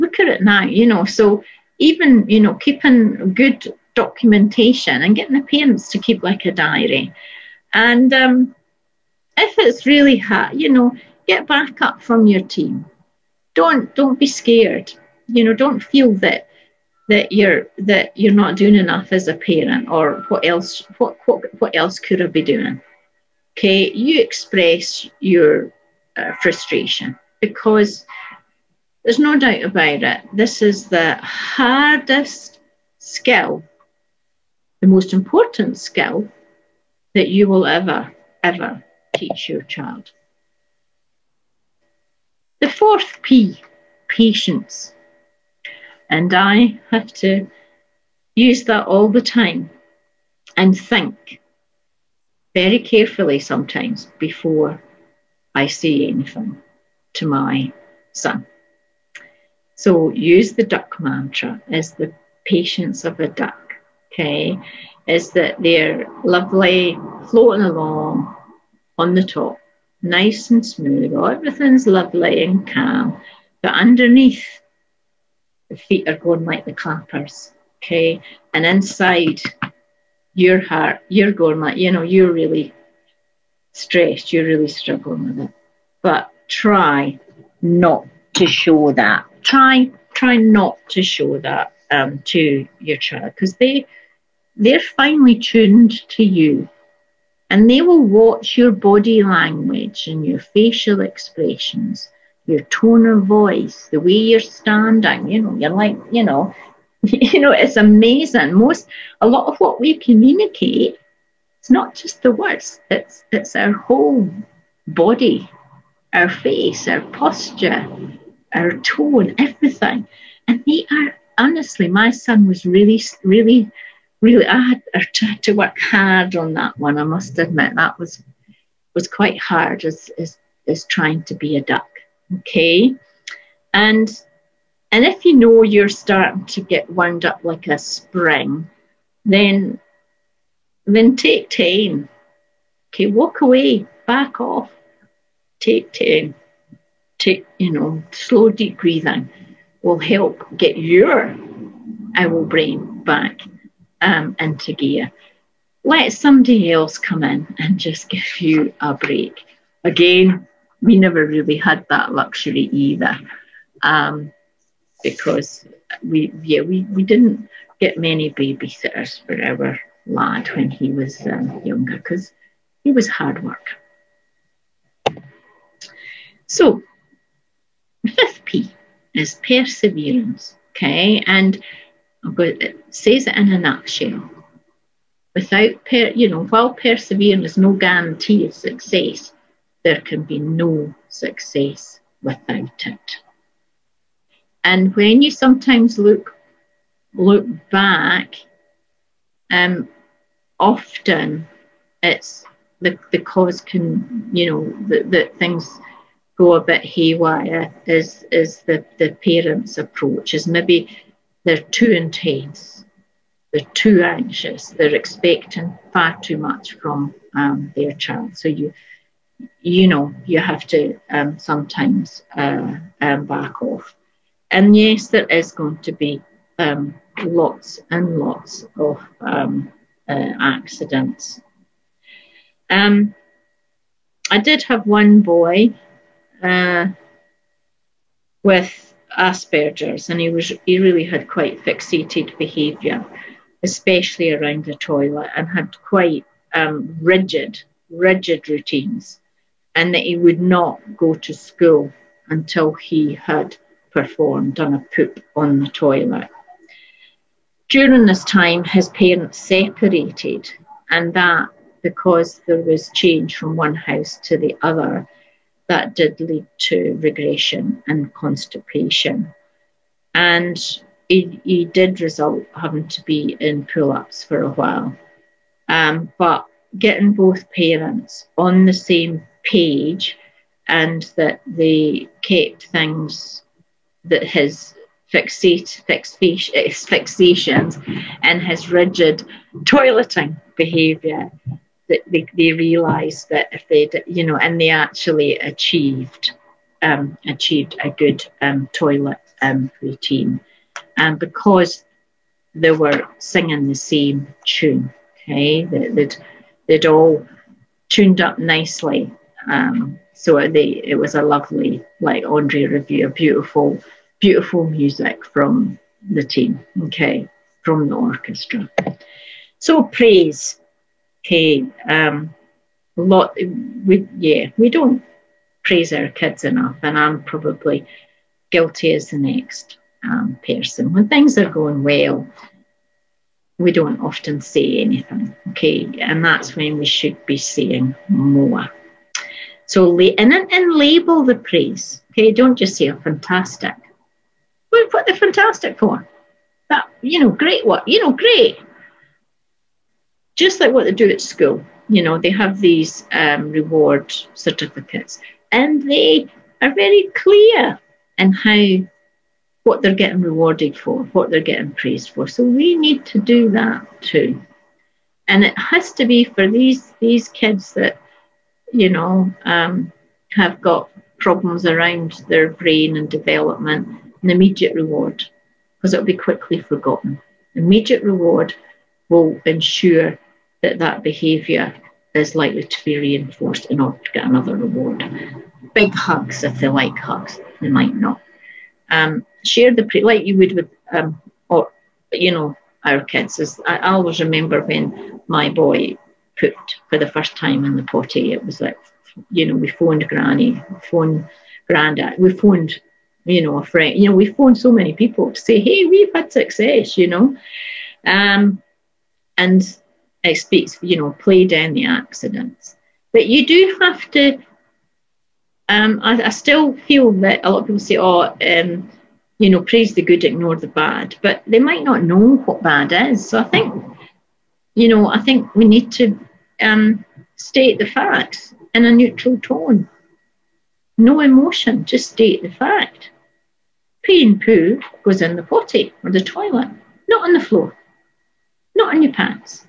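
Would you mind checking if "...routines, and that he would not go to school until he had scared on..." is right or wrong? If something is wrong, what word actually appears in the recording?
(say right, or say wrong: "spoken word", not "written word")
wrong: "performed", not "scared".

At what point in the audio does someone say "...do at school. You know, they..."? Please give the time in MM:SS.
05:50.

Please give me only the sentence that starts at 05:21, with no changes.
Um, lot we yeah we don't praise our kids enough, and I'm probably guilty as the next um, person.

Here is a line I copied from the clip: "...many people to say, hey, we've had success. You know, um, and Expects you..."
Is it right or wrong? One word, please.
right.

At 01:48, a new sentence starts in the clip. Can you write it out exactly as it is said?
Most, a lot of what we communicate, it's not just the words.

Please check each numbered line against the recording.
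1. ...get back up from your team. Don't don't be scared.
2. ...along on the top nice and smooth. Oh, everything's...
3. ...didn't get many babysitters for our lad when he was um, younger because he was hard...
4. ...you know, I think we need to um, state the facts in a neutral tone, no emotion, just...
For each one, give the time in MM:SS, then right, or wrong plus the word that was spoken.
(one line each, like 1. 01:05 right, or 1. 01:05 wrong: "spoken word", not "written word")
1. 00:11 right
2. 01:07 right
3. 02:47 right
4. 07:04 right.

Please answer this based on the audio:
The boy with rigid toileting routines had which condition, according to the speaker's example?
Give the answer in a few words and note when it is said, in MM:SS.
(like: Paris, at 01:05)
Asperger's, at 03:59.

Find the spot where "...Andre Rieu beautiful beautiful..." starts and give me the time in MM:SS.
05:12.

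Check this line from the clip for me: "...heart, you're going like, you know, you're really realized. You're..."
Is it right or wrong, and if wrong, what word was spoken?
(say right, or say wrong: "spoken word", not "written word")
wrong: "stressed", not "realized".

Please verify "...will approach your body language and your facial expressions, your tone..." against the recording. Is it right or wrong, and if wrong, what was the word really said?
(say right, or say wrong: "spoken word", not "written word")
wrong: "watch", not "approach".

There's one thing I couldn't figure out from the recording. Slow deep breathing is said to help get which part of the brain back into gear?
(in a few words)
Owl brain.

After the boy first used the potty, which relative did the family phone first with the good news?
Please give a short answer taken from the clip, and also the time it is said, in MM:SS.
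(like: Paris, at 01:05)
Granny, at 06:40.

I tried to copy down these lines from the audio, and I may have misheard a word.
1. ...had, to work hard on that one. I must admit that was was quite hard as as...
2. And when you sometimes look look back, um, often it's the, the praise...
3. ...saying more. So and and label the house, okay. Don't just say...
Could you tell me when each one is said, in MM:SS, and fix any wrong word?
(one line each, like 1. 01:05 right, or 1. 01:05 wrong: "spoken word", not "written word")
1. 02:04 right
2. 03:14 wrong: "cause", not "praise"
3. 05:37 wrong: "praise", not "house".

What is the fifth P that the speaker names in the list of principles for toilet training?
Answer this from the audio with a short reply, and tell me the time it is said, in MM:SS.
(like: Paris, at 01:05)
Perseverance, at 02:59.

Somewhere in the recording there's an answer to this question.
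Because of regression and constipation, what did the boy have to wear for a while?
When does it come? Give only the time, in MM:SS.
04:33.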